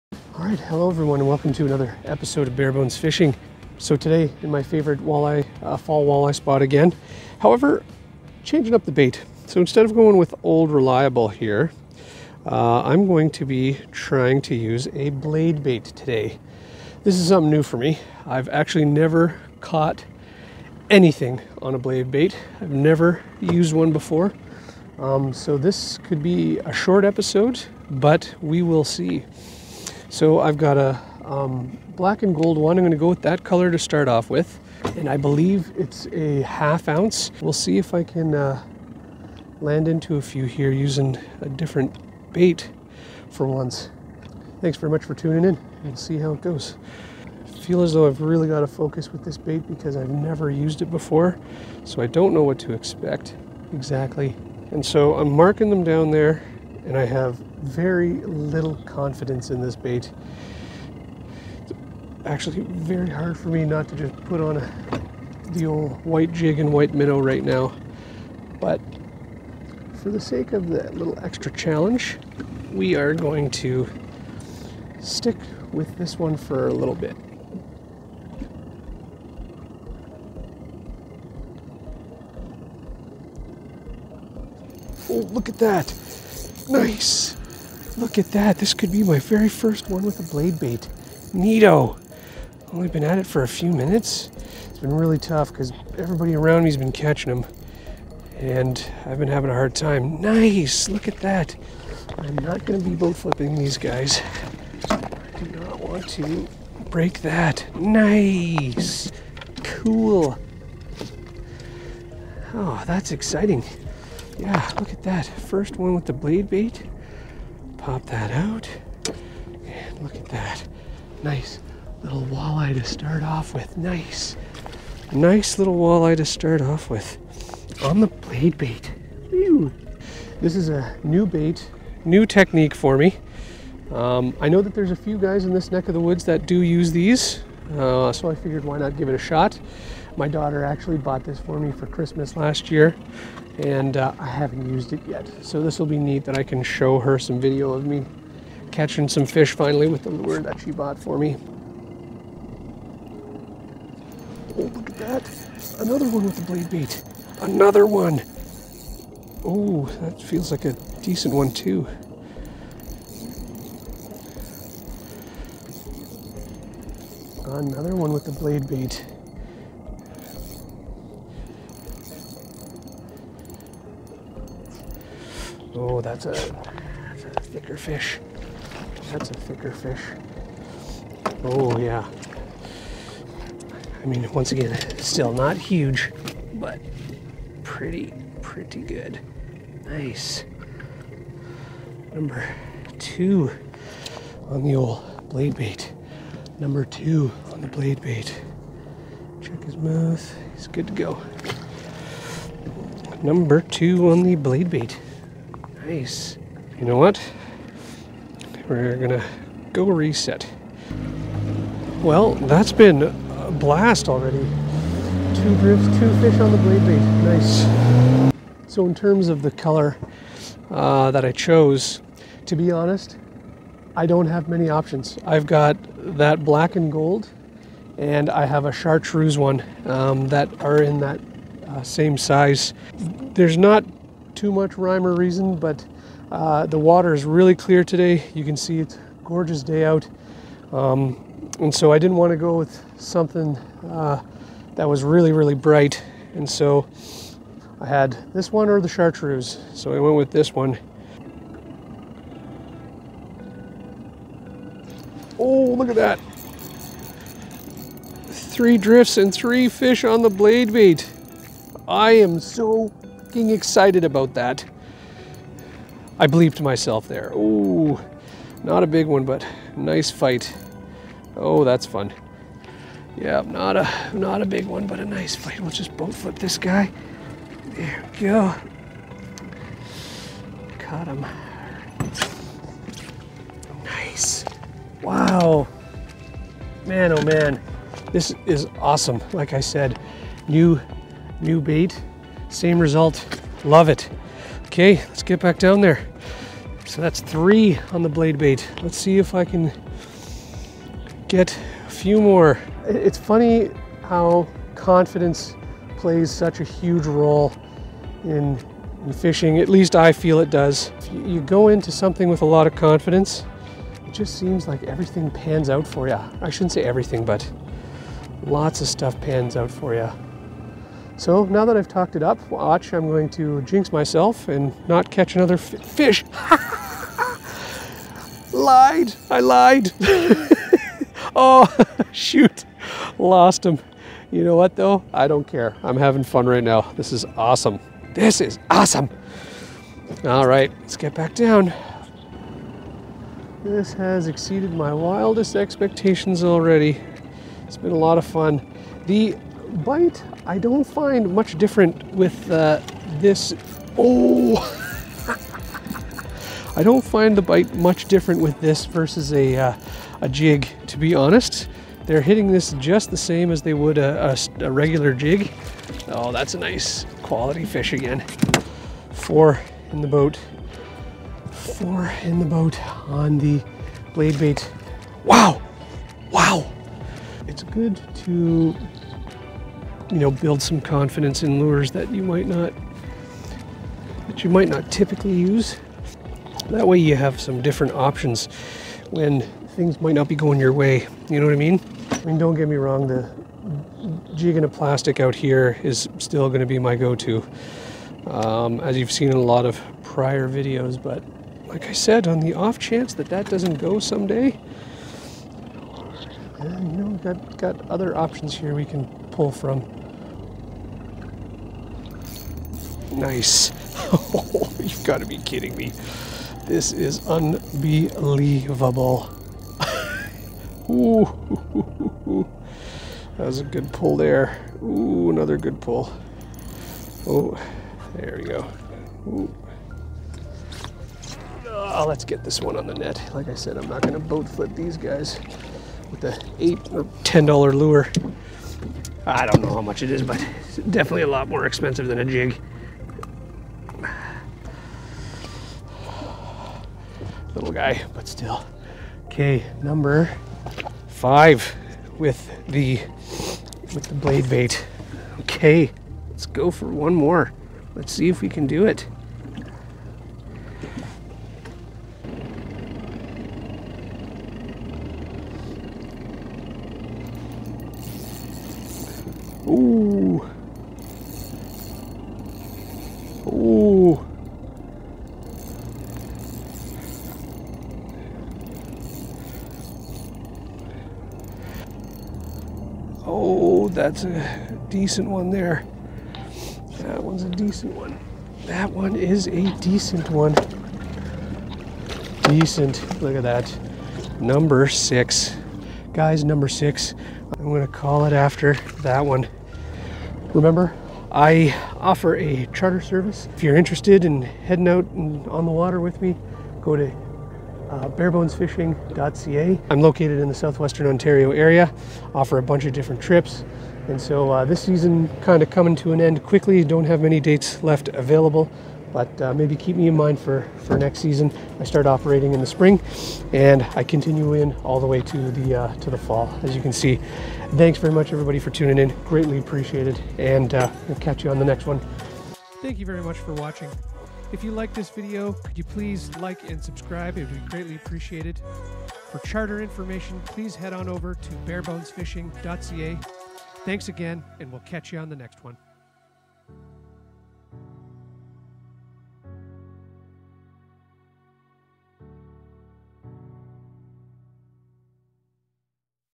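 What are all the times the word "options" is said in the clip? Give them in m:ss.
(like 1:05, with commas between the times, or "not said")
3:44, 6:27, 6:48.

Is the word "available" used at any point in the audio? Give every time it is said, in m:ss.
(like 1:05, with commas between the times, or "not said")
8:38.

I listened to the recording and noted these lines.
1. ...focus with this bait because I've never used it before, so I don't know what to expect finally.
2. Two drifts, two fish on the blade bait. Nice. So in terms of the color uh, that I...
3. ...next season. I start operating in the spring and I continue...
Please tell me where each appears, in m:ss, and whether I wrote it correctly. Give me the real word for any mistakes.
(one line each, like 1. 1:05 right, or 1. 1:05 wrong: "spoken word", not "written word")
1. 0:48 wrong: "exactly", not "finally"
2. 3:35 right
3. 8:40 right.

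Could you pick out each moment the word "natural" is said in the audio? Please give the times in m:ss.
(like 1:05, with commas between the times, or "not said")
not said.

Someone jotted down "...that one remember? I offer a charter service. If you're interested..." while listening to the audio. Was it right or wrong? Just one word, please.
right.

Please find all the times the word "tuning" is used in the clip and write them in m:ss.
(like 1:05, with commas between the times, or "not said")
0:45, 8:48.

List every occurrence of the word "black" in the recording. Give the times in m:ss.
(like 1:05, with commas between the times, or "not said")
0:31, 3:46.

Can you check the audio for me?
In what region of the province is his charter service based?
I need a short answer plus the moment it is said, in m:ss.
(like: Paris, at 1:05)
southwestern Ontario, at 8:30.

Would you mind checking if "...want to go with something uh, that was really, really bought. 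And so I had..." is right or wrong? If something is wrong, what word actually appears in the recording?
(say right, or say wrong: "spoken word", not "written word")
wrong: "bright", not "bought".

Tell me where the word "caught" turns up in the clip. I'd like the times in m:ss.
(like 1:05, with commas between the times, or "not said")
0:19, 4:40.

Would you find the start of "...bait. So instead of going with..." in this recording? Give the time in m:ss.
0:08.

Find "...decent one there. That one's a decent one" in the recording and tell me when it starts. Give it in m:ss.
8:04.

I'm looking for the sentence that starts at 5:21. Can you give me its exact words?
So now that I've talked it up, watch, I'm going to jinx myself and not catch another fish.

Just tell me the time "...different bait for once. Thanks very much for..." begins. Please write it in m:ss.
0:41.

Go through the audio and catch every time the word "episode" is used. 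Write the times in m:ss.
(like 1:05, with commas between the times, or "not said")
0:02, 0:27.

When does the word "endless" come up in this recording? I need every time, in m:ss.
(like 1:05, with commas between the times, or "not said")
not said.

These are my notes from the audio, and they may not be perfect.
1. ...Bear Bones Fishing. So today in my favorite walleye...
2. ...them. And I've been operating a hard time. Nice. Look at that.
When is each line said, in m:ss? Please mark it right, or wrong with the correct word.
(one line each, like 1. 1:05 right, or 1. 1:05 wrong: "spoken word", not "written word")
1. 0:02 right
2. 1:37 wrong: "having", not "operating".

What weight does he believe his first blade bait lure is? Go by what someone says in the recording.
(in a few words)
half ounce.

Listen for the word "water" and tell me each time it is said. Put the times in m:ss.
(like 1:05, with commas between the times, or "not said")
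3:56, 8:25.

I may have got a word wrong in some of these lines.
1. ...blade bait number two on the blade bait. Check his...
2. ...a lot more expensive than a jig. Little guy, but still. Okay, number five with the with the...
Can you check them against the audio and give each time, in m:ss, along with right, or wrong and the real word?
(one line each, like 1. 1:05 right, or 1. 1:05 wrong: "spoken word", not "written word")
1. 3:15 right
2. 7:21 right.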